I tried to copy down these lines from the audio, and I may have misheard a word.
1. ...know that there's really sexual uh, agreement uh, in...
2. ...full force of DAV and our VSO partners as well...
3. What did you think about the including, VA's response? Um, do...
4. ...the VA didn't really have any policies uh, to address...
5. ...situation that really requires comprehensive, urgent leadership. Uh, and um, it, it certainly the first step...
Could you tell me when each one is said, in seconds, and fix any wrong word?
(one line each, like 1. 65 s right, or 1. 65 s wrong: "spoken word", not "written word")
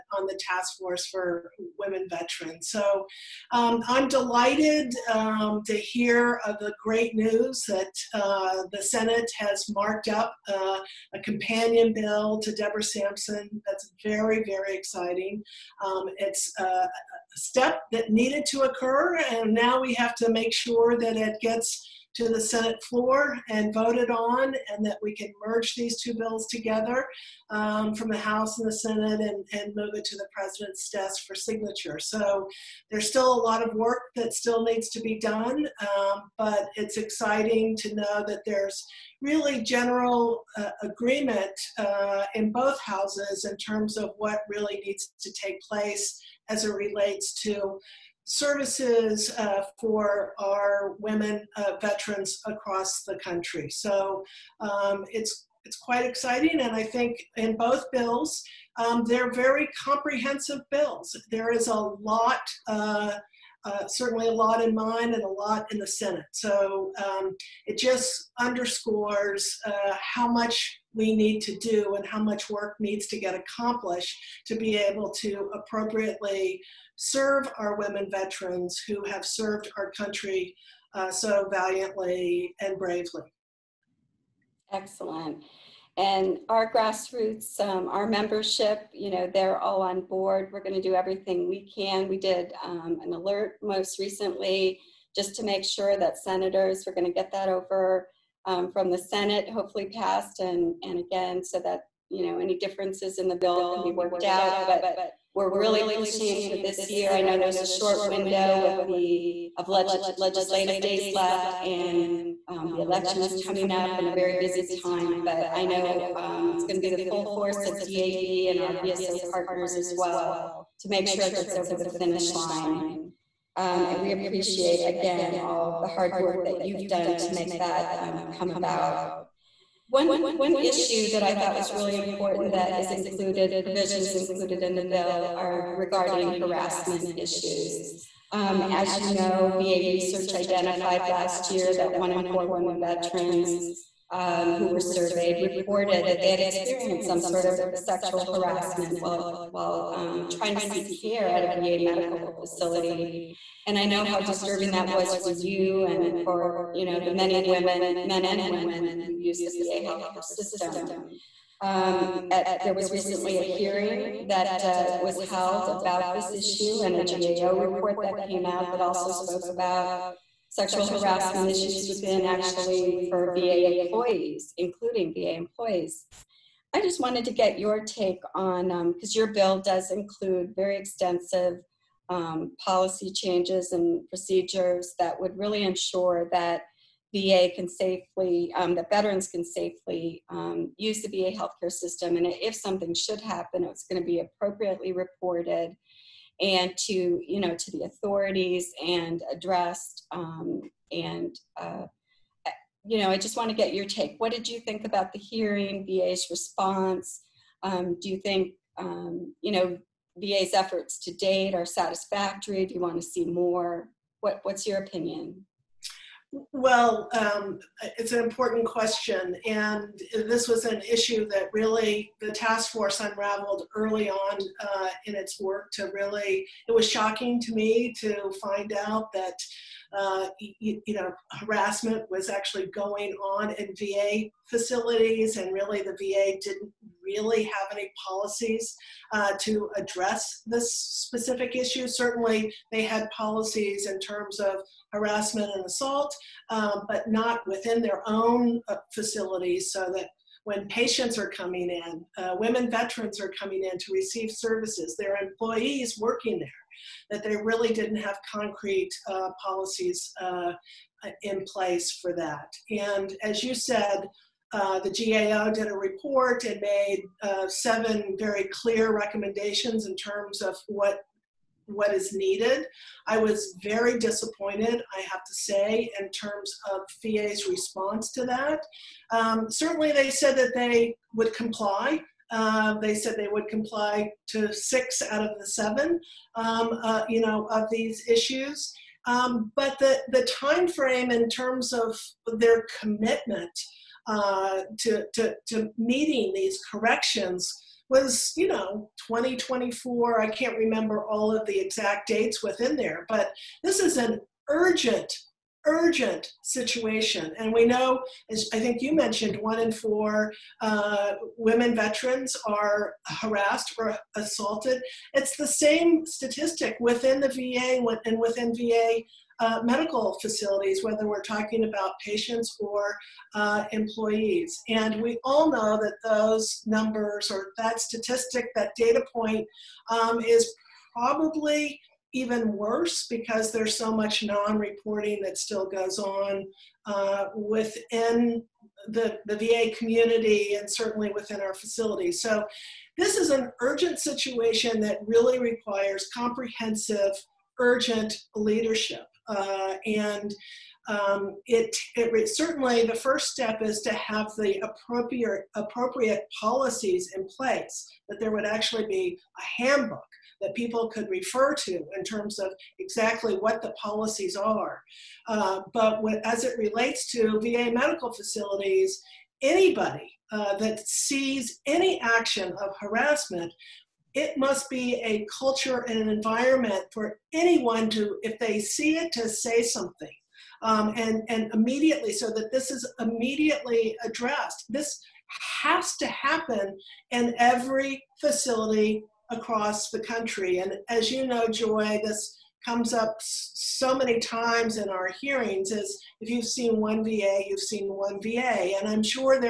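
1. 37 s wrong: "general", not "sexual"
2. 117 s right
3. 204 s wrong: "hearing", not "including"
4. 235 s right
5. 343 s right.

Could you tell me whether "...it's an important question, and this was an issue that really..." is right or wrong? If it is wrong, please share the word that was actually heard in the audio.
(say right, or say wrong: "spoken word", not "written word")
right.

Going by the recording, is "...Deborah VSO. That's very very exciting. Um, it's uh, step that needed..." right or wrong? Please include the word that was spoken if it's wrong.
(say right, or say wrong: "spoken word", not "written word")
wrong: "Sampson", not "VSO".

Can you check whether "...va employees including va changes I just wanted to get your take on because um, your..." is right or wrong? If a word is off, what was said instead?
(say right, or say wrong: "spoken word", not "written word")
wrong: "employees", not "changes".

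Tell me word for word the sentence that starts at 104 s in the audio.
But we're really pushing for this year.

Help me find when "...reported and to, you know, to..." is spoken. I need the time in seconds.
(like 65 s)
194 s.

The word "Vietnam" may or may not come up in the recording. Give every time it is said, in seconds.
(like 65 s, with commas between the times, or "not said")
not said.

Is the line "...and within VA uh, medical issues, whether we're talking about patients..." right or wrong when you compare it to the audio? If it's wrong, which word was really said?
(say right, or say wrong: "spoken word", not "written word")
wrong: "facilities", not "issues".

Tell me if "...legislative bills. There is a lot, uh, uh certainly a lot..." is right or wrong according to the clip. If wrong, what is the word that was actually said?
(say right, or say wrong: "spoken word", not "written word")
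wrong: "comprehensive", not "legislative".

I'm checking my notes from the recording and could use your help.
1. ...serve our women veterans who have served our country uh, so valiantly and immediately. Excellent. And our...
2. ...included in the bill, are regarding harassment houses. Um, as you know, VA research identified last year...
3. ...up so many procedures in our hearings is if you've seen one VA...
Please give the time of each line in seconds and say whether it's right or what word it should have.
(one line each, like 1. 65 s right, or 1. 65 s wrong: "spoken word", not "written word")
1. 76 s wrong: "bravely", not "immediately"
2. 134 s wrong: "issues", not "houses"
3. 392 s wrong: "times", not "procedures".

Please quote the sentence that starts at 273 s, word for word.
I was very disappointed, I have to say, in terms of VA's response to that.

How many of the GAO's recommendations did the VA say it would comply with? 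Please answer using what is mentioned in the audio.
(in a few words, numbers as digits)
6.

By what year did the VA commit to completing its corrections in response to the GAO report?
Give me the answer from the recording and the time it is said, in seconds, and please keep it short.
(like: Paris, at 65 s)
2024, at 299 s.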